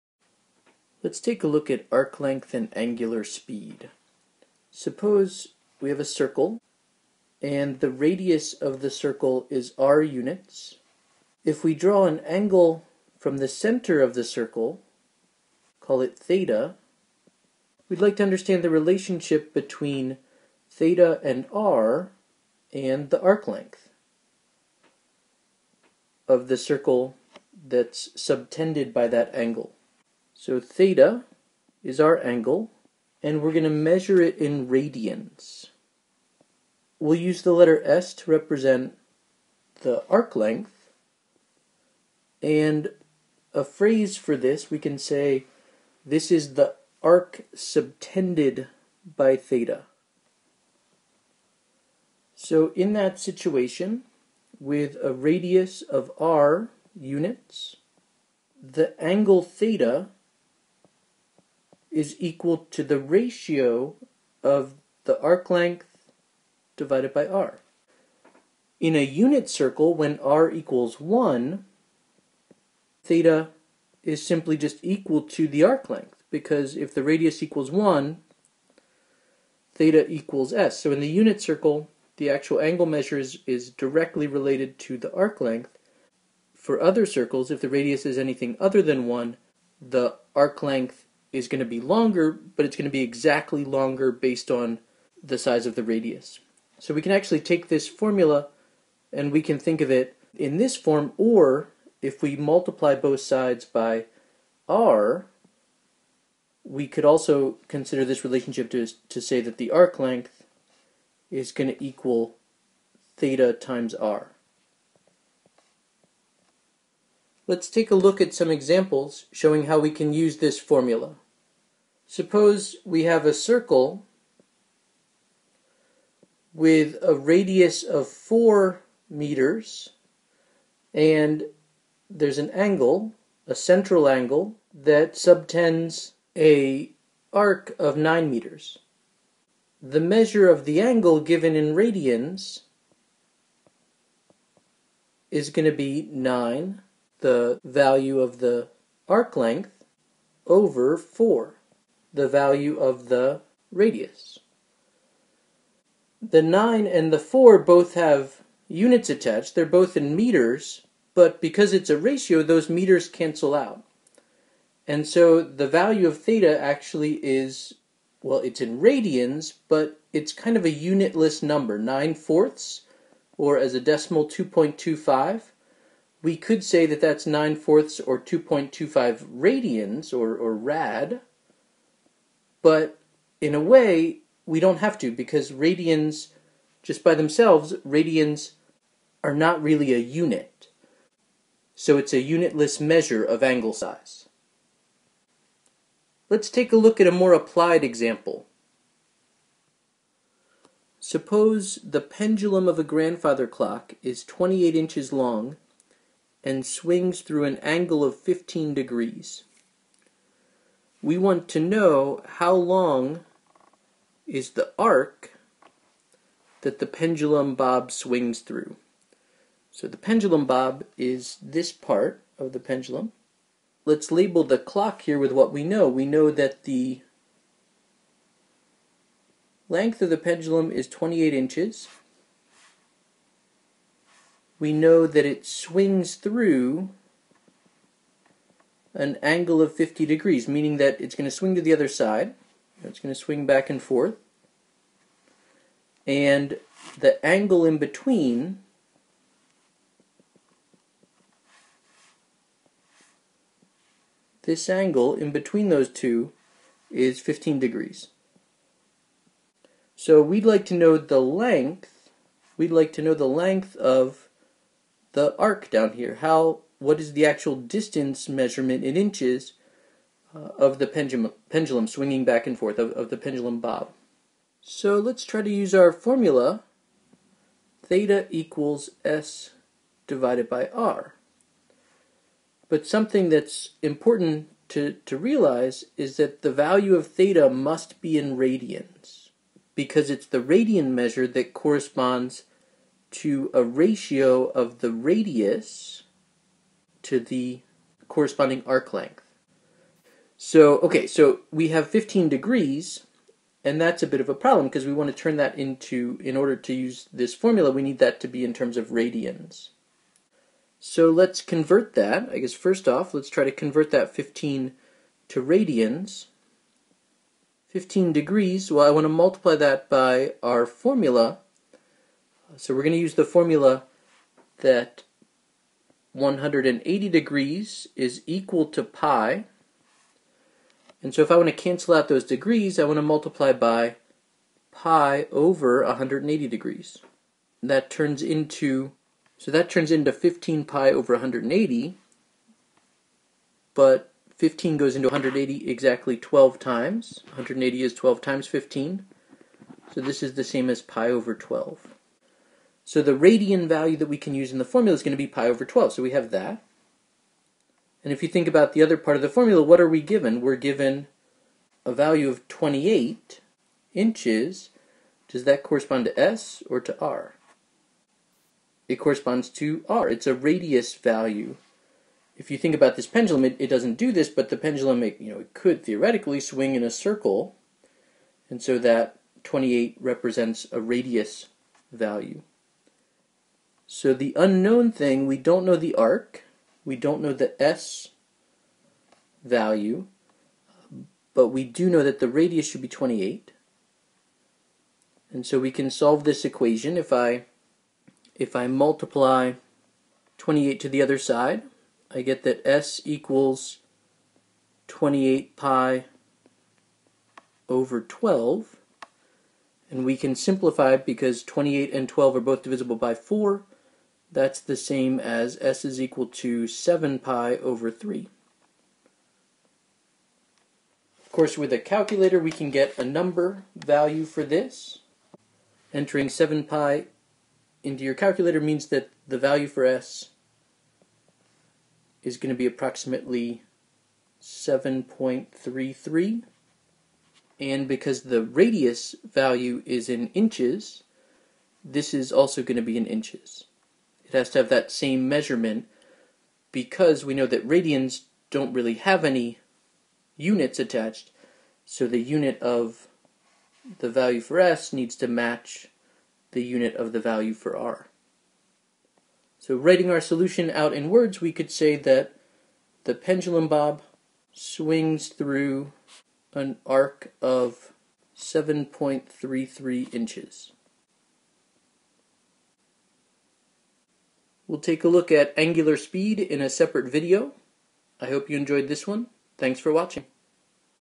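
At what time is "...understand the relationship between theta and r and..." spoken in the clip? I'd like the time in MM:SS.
00:18.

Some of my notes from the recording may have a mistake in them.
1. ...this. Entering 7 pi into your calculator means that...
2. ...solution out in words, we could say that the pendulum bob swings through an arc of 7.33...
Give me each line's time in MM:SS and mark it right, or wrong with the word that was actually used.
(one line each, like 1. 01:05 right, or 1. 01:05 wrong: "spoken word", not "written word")
1. 07:04 right
2. 07:40 right.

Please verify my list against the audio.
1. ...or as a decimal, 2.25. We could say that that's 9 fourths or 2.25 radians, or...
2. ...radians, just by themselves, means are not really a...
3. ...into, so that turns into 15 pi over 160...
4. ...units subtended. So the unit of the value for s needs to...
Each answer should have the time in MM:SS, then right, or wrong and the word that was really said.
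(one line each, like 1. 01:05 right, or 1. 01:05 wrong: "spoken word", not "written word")
1. 02:53 right
2. 03:05 wrong: "radians", not "means"
3. 05:38 wrong: "180", not "160"
4. 07:30 wrong: "attached", not "subtended".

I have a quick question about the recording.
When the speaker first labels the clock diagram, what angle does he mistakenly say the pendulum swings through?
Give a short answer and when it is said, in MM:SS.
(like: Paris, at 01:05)
50 degrees, at 03:59.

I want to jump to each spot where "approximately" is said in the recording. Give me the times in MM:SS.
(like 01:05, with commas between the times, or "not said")
07:12.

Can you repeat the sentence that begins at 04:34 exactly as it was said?
So let's try to use our formula, theta equals S divided by R.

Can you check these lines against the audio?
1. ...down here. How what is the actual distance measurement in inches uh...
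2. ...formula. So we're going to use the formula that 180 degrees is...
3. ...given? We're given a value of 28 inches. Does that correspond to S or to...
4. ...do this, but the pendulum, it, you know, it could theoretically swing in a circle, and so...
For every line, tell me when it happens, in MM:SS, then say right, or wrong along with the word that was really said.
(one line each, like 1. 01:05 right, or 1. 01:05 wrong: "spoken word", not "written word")
1. 04:25 right
2. 05:20 right
3. 06:00 right
4. 06:13 right.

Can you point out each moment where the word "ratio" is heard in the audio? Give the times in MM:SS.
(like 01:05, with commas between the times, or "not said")
01:02, 02:41, 04:53.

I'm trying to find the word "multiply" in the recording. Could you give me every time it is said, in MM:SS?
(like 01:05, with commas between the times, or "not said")
01:42, 05:19, 05:33, 06:38.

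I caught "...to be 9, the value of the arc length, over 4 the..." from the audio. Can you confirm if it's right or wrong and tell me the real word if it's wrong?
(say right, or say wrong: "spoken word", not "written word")
right.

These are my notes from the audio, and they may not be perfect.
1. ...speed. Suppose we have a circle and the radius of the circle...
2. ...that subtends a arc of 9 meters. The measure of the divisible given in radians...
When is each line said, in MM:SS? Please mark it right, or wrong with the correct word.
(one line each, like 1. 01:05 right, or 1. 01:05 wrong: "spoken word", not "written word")
1. 00:03 right
2. 02:14 wrong: "angle", not "divisible".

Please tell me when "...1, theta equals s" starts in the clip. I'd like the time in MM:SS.
01:17.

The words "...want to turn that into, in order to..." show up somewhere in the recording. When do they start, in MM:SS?
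05:04.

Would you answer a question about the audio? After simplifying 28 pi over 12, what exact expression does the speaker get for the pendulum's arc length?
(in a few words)
7 pi over 3.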